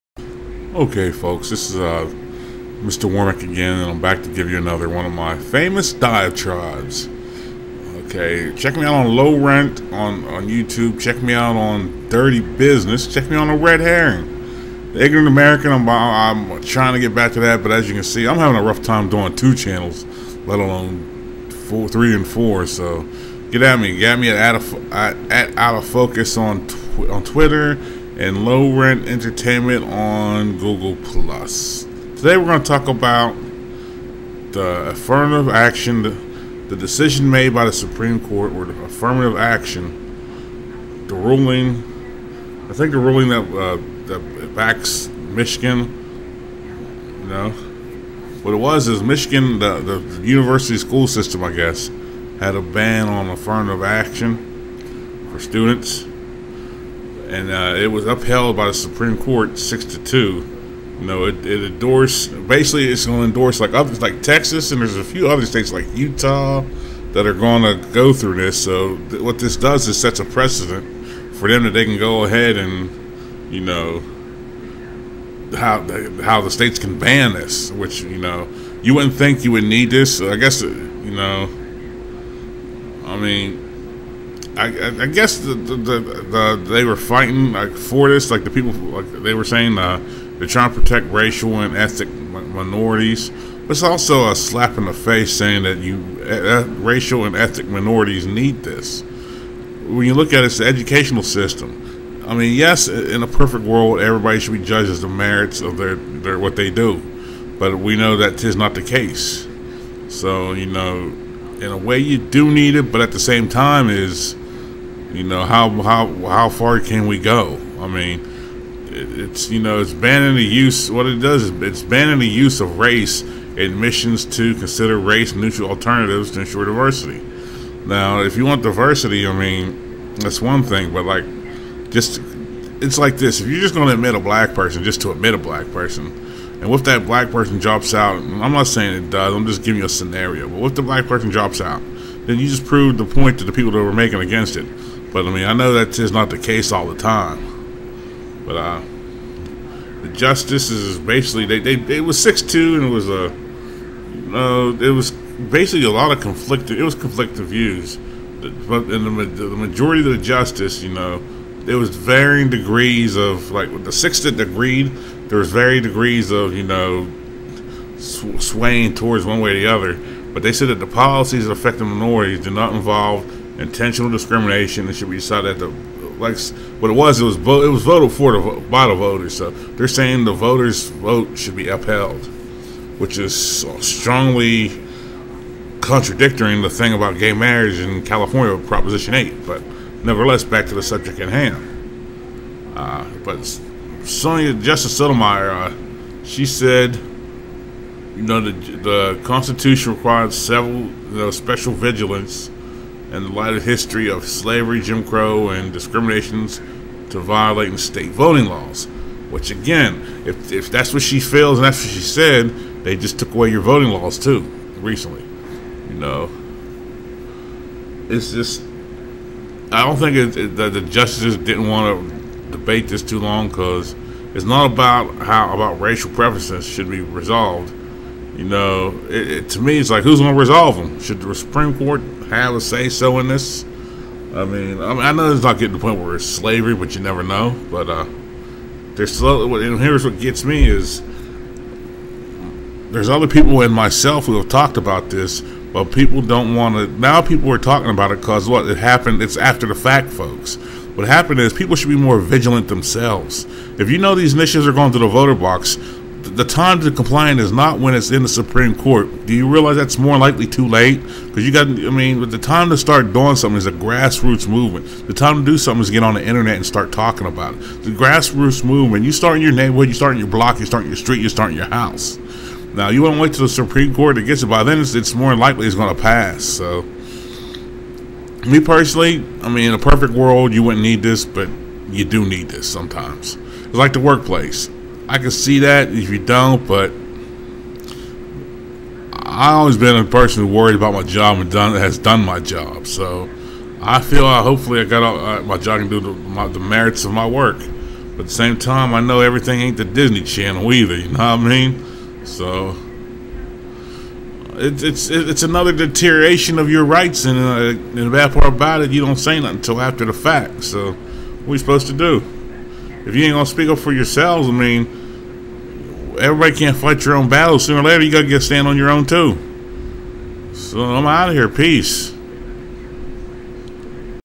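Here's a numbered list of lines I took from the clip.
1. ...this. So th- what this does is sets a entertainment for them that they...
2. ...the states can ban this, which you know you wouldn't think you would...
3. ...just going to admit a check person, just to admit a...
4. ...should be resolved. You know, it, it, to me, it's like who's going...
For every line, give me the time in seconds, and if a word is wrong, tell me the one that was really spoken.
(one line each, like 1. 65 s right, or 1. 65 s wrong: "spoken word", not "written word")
1. 68 s wrong: "precedent", not "entertainment"
2. 76 s right
3. 133 s wrong: "black", not "check"
4. 226 s right.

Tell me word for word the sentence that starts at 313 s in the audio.
if you ain't gonna speak up for yourselves, I mean, everybody can't fight your own battles.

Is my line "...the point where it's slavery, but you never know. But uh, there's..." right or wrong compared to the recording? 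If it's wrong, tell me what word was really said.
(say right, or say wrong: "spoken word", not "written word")
right.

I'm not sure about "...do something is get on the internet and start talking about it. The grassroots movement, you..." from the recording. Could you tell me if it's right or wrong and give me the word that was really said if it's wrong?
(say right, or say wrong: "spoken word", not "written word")
right.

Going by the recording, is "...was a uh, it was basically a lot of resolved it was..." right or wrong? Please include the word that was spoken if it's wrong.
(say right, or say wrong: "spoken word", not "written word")
wrong: "conflicted", not "resolved".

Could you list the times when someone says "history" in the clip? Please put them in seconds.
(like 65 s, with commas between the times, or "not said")
203 s.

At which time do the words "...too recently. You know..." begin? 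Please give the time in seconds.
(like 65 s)
214 s.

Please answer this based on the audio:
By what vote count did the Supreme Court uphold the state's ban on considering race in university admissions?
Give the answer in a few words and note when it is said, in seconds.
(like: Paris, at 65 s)
6 to 2, at 59 s.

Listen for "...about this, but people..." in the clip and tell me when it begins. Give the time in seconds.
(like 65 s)
244 s.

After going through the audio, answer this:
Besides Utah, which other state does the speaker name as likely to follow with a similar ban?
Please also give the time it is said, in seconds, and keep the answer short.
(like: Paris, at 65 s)
Texas, at 64 s.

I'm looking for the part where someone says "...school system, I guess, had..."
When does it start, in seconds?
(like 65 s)
50 s.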